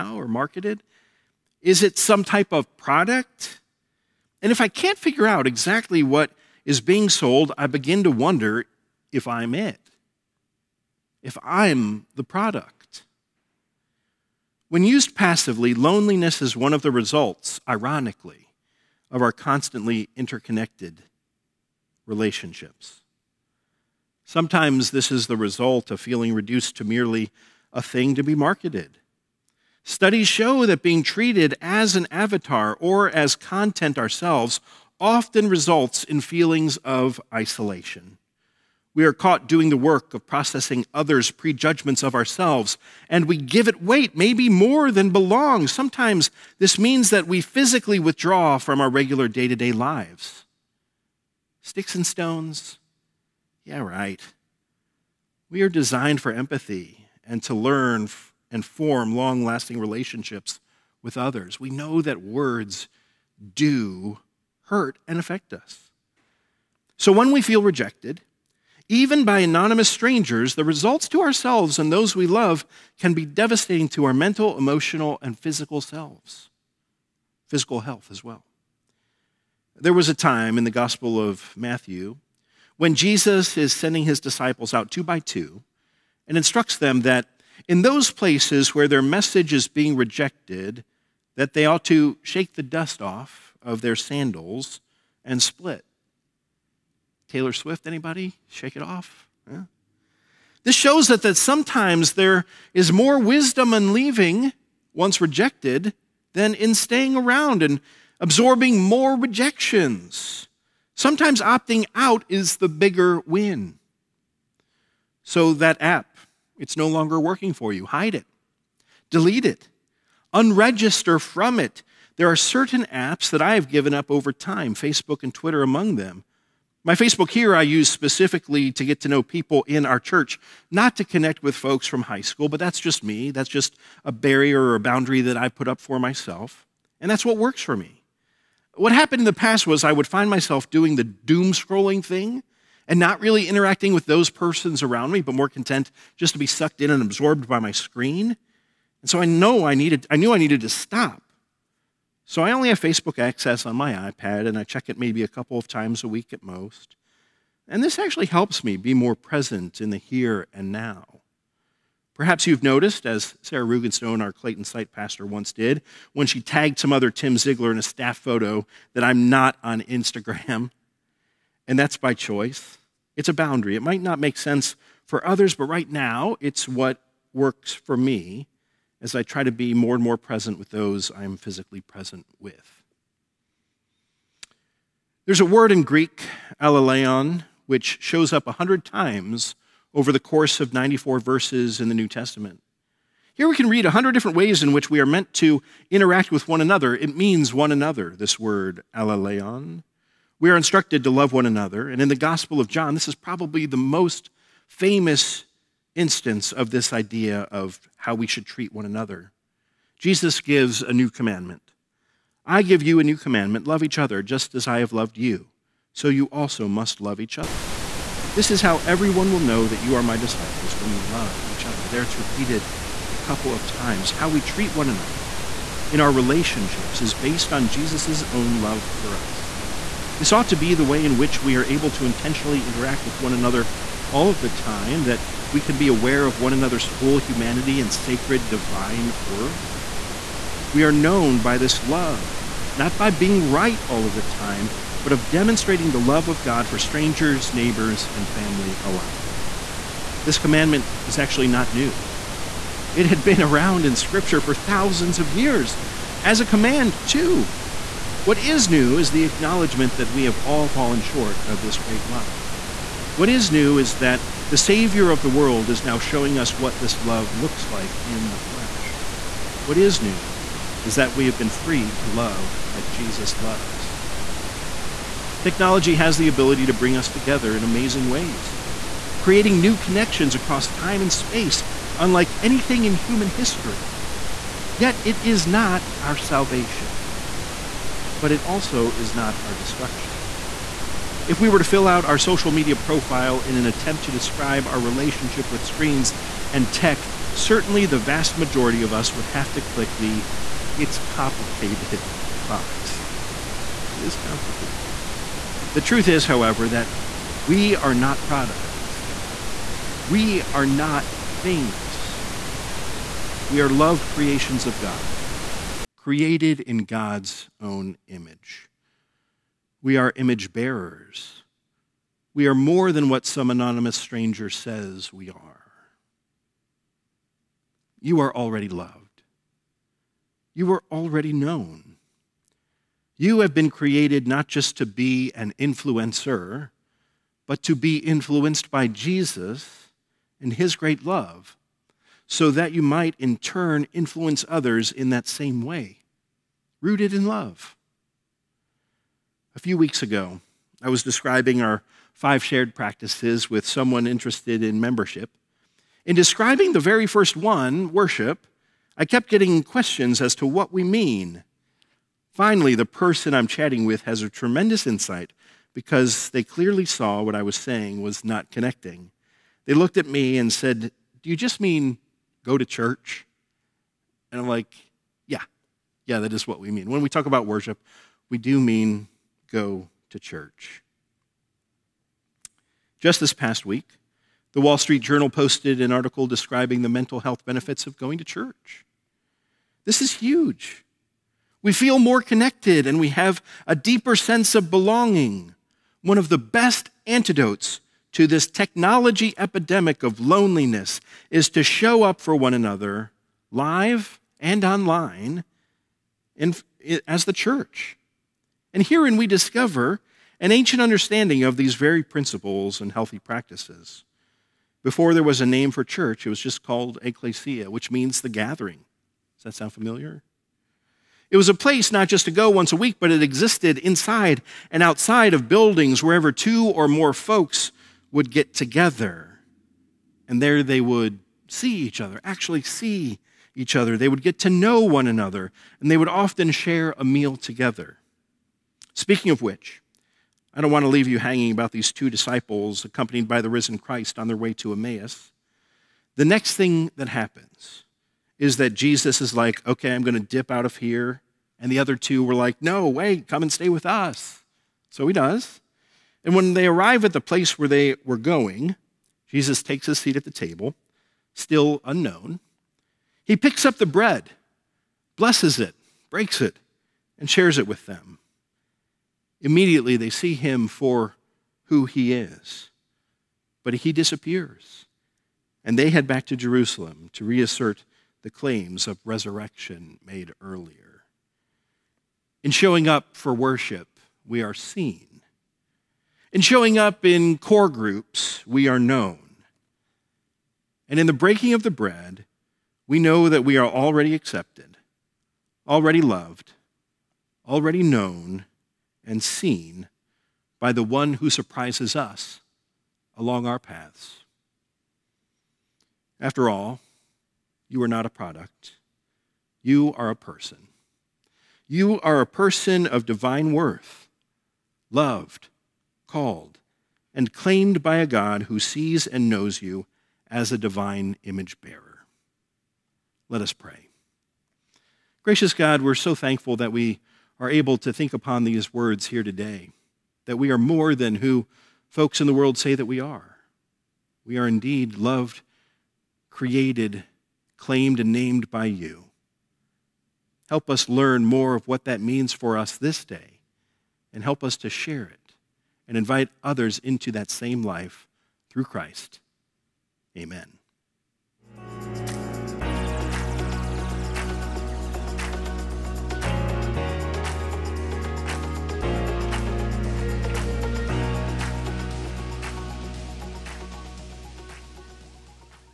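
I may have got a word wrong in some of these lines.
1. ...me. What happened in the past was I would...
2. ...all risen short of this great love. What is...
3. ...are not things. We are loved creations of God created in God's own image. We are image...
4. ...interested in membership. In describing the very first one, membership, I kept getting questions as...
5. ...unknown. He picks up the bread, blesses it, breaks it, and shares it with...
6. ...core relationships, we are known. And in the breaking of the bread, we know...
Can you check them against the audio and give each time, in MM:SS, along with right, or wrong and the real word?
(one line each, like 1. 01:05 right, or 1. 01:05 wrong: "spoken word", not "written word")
1. 02:17 right
2. 04:20 wrong: "fallen", not "risen"
3. 05:10 right
4. 05:54 wrong: "worship", not "membership"
5. 07:41 right
6. 08:07 wrong: "groups", not "relationships".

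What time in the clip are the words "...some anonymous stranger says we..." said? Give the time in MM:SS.
05:23.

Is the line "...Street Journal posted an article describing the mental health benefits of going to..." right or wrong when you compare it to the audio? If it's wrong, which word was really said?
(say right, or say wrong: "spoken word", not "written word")
right.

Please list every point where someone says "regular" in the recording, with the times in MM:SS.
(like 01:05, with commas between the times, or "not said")
00:48.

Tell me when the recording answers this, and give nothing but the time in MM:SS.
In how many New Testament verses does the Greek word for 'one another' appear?
03:10.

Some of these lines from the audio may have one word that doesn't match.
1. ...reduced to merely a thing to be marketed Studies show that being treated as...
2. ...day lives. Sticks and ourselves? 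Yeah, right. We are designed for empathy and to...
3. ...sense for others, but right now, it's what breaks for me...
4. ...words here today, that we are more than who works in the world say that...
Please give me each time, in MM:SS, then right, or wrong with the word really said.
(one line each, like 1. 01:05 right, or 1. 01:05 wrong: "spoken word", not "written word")
1. 00:26 right
2. 00:49 wrong: "stones", not "ourselves"
3. 02:54 wrong: "works", not "breaks"
4. 08:48 wrong: "folks", not "works".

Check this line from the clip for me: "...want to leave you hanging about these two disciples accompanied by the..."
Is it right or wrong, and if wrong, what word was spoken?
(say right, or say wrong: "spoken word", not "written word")
right.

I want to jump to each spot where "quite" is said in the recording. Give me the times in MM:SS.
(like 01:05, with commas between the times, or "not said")
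not said.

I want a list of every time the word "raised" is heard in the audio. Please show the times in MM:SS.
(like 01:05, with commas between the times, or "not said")
not said.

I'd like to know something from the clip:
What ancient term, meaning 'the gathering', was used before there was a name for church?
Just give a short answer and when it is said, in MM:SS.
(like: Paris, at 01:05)
ecclesia, at 06:57.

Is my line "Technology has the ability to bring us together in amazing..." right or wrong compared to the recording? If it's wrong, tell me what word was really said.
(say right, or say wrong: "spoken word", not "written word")
right.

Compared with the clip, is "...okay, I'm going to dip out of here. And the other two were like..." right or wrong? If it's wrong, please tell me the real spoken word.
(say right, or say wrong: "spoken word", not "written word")
right.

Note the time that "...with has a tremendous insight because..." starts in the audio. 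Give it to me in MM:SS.
06:03.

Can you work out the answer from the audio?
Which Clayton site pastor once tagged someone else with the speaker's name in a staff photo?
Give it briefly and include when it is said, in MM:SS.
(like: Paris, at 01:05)
Sarah Rugenstone, at 02:43.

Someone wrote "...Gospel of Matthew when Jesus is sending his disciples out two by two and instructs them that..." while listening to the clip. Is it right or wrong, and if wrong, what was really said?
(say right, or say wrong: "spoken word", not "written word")
right.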